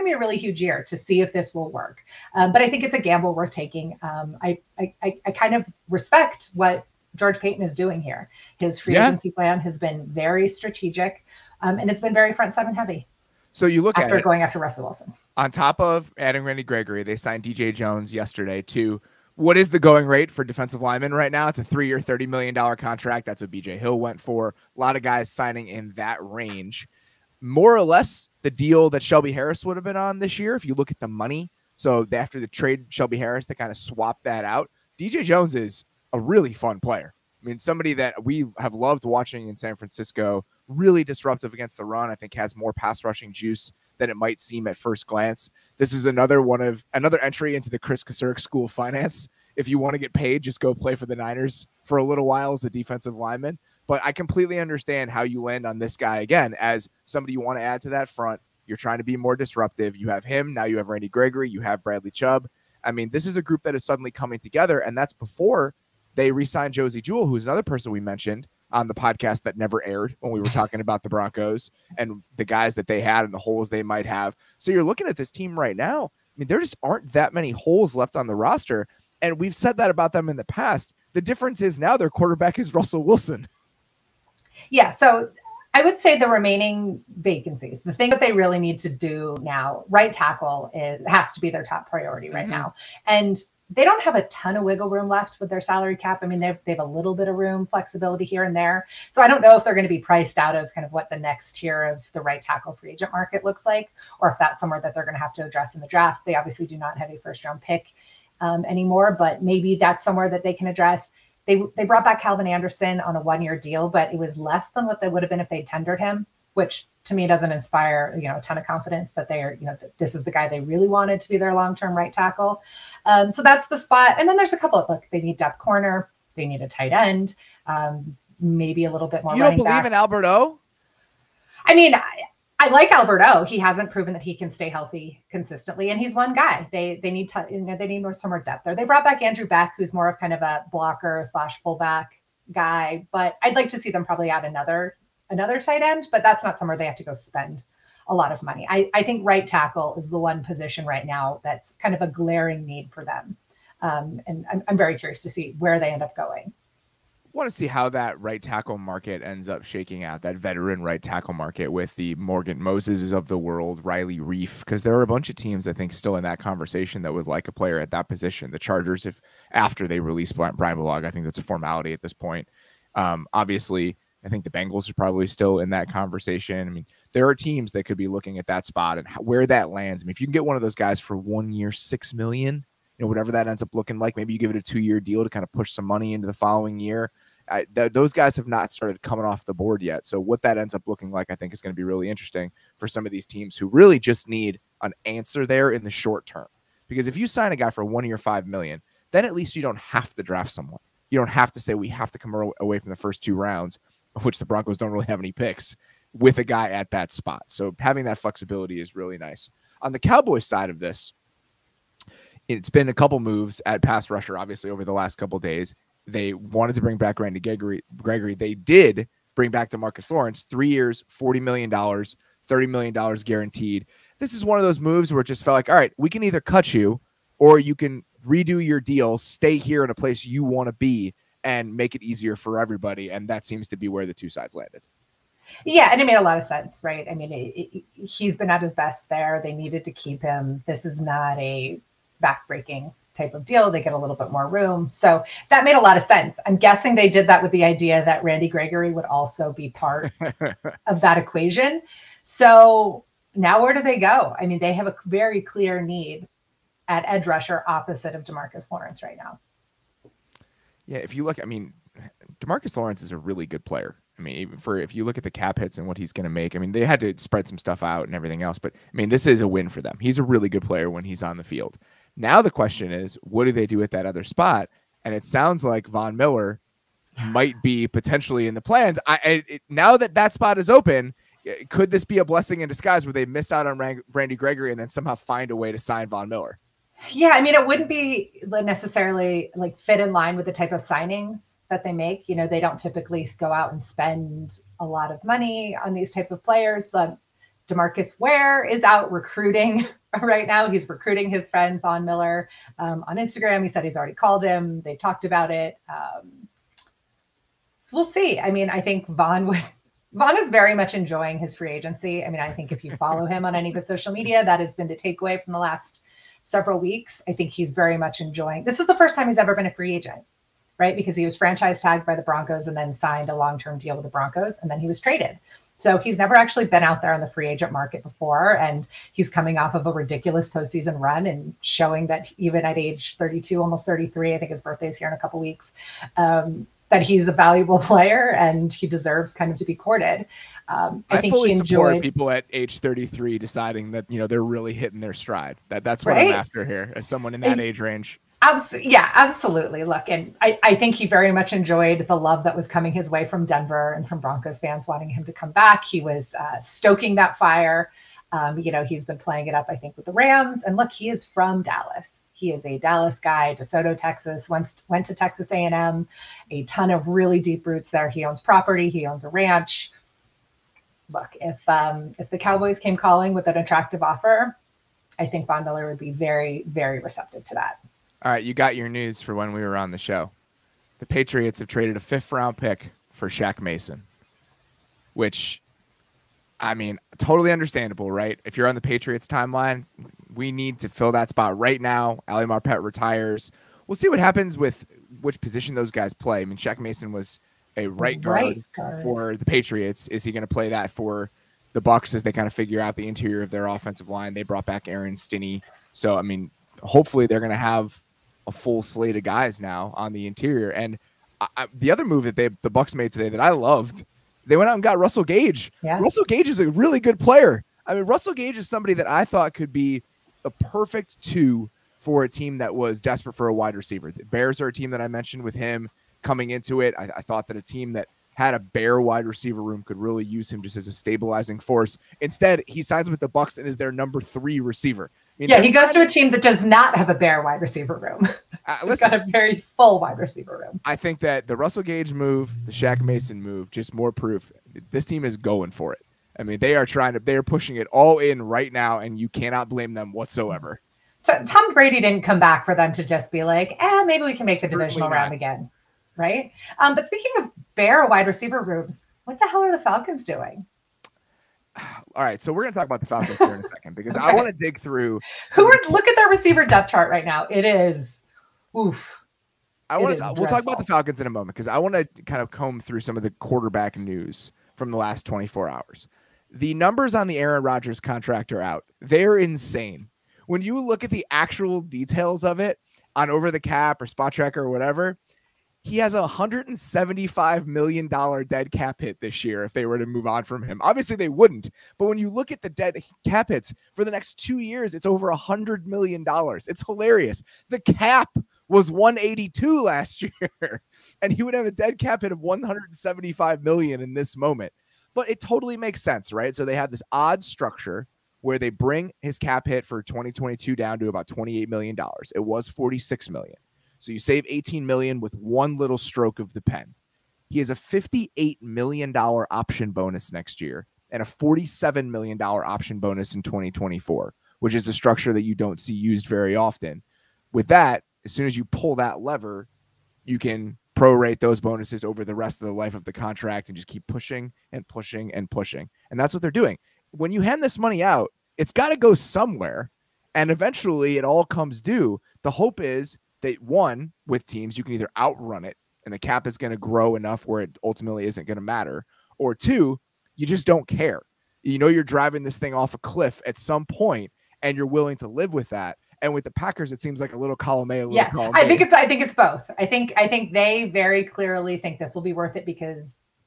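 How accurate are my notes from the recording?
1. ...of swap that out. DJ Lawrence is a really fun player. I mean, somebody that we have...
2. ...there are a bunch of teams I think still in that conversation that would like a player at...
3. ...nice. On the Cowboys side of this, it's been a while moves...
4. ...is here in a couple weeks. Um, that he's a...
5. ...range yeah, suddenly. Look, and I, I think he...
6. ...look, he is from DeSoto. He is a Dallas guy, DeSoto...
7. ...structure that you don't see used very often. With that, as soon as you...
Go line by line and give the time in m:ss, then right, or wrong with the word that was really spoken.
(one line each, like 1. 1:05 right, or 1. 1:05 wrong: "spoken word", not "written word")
1. 0:33 wrong: "Jones", not "Lawrence"
2. 2:44 right
3. 3:29 wrong: "couple", not "while"
4. 5:34 right
5. 5:47 wrong: "absolutely", not "suddenly"
6. 6:00 wrong: "Dallas", not "DeSoto"
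7. 8:44 right.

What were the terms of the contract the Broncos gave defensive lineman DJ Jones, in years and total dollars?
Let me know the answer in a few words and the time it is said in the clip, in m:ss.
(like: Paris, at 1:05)
3 years, $30 million, at 0:21.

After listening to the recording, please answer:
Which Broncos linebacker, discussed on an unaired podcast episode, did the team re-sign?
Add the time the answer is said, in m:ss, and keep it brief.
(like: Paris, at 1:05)
Josey Jewell, at 1:06.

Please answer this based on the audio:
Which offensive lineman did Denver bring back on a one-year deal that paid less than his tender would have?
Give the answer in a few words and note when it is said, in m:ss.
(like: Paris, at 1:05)
Calvin Anderson, at 1:52.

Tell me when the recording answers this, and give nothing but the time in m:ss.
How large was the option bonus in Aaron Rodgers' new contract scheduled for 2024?
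8:41.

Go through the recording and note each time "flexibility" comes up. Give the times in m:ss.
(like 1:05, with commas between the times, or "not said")
1:37, 3:28.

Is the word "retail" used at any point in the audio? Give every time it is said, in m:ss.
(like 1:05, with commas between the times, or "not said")
not said.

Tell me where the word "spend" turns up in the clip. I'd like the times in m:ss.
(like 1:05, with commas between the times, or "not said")
2:27, 4:53.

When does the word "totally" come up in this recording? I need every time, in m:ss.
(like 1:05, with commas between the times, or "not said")
6:27, 8:25.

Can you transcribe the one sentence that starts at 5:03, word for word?
He said he's already called him.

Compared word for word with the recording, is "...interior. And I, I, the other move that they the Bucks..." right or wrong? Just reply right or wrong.
right.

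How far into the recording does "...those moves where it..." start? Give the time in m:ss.
3:44.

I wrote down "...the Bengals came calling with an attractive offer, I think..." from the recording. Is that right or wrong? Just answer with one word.
wrong.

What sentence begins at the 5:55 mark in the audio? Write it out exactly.
He was uh, stoking that fire.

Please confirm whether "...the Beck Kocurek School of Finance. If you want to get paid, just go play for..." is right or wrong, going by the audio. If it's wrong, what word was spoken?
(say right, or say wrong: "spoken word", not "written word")
wrong: "Kris", not "Beck".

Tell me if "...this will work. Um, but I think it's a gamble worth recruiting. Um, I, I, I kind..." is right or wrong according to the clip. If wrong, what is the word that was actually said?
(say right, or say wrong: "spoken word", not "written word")
wrong: "taking", not "recruiting".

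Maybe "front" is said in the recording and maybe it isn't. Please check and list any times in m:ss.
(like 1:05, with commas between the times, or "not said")
0:12, 0:58.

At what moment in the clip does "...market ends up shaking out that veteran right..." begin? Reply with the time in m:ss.
2:38.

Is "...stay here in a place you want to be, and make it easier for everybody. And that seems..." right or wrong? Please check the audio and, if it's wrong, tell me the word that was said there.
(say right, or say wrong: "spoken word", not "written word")
right.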